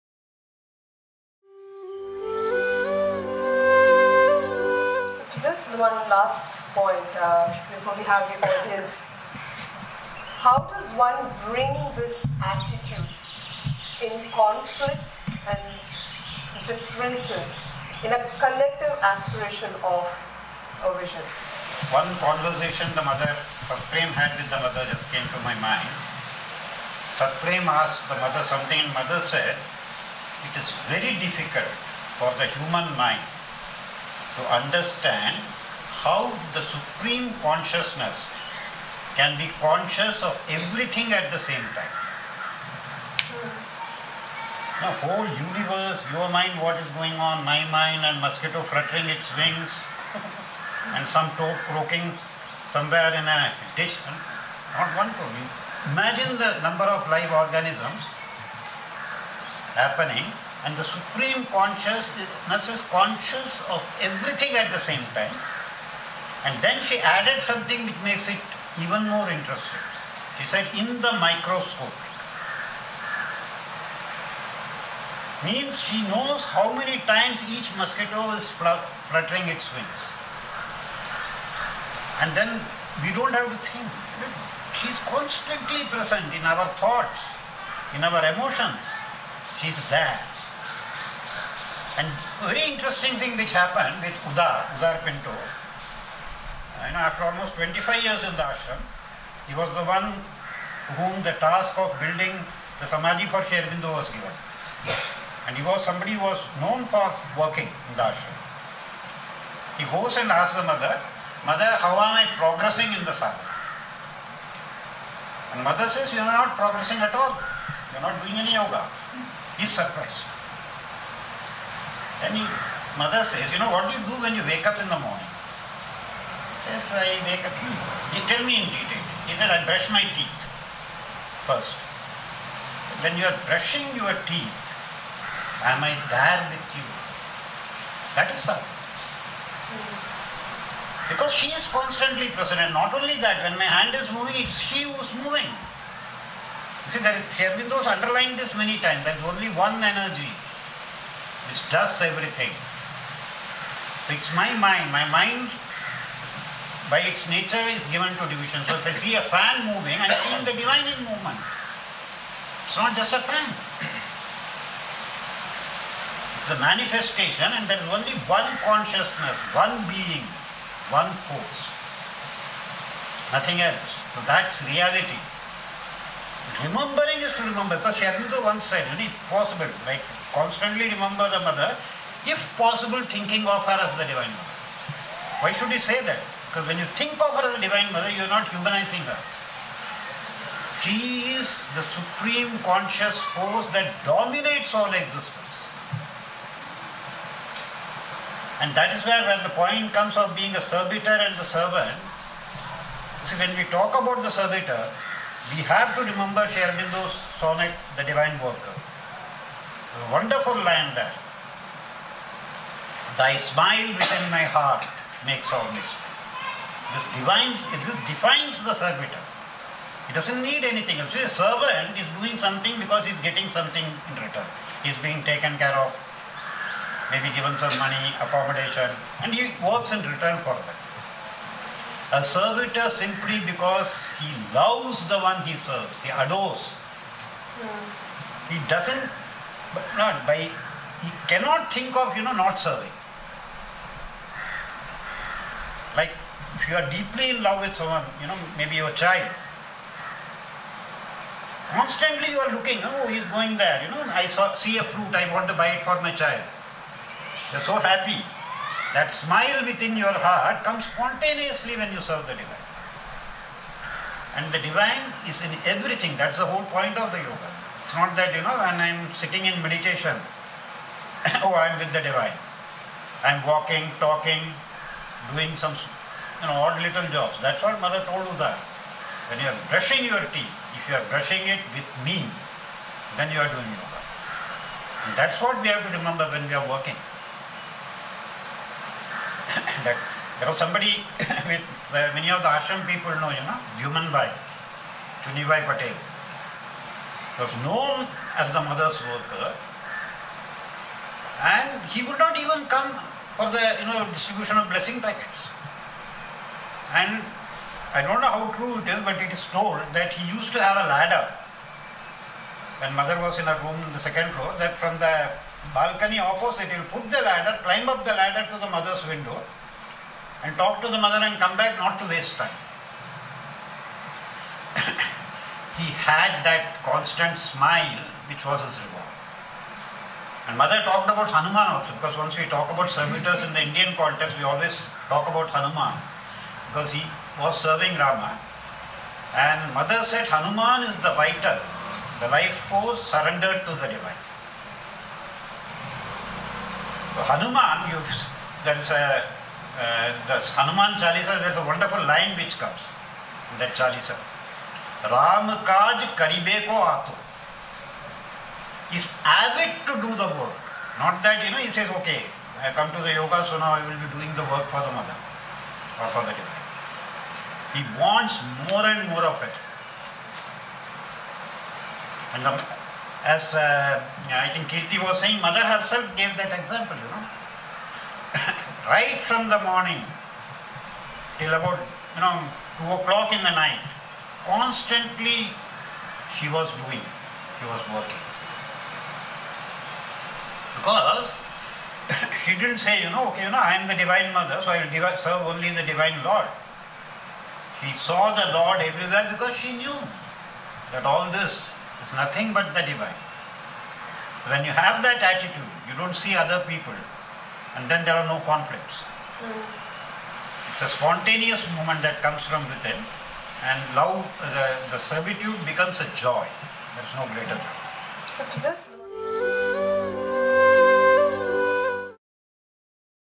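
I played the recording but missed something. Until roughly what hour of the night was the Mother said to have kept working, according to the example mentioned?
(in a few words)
2 o'clock.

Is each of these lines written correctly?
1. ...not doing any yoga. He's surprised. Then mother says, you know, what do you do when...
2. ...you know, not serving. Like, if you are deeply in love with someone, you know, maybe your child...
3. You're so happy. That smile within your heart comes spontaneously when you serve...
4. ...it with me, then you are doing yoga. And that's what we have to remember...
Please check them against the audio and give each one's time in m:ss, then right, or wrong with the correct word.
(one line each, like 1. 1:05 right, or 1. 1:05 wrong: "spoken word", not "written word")
1. 1:58 right
2. 4:02 right
3. 4:17 right
4. 4:41 right.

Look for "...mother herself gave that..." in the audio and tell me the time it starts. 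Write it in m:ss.
6:15.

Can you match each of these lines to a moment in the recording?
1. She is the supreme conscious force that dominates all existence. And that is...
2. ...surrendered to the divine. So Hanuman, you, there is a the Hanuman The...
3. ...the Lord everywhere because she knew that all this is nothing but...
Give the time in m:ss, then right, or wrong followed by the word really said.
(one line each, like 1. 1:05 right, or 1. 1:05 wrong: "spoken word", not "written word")
1. 3:10 right
2. 5:43 wrong: "Chalisa", not "The"
3. 6:38 right.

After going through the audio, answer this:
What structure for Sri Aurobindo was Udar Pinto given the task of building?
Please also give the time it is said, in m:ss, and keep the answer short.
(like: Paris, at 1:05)
the samadhi, at 1:42.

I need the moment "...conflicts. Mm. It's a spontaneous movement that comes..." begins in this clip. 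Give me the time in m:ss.
6:48.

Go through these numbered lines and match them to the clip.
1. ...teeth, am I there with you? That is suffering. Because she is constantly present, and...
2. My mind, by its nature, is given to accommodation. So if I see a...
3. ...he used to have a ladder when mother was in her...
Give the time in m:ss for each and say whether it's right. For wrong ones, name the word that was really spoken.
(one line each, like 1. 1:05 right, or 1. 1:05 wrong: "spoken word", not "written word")
1. 2:14 right
2. 2:34 wrong: "division", not "accommodation"
3. 5:10 right.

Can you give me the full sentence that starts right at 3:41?
A servant is doing something because he's getting something in return.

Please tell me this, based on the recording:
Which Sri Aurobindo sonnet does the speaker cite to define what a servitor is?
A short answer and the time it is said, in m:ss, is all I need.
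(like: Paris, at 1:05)
The Divine Worker, at 3:27.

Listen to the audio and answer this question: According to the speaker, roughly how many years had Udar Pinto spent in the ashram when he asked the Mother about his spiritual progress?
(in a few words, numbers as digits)
25 years.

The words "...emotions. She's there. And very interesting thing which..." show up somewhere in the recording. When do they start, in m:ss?
1:28.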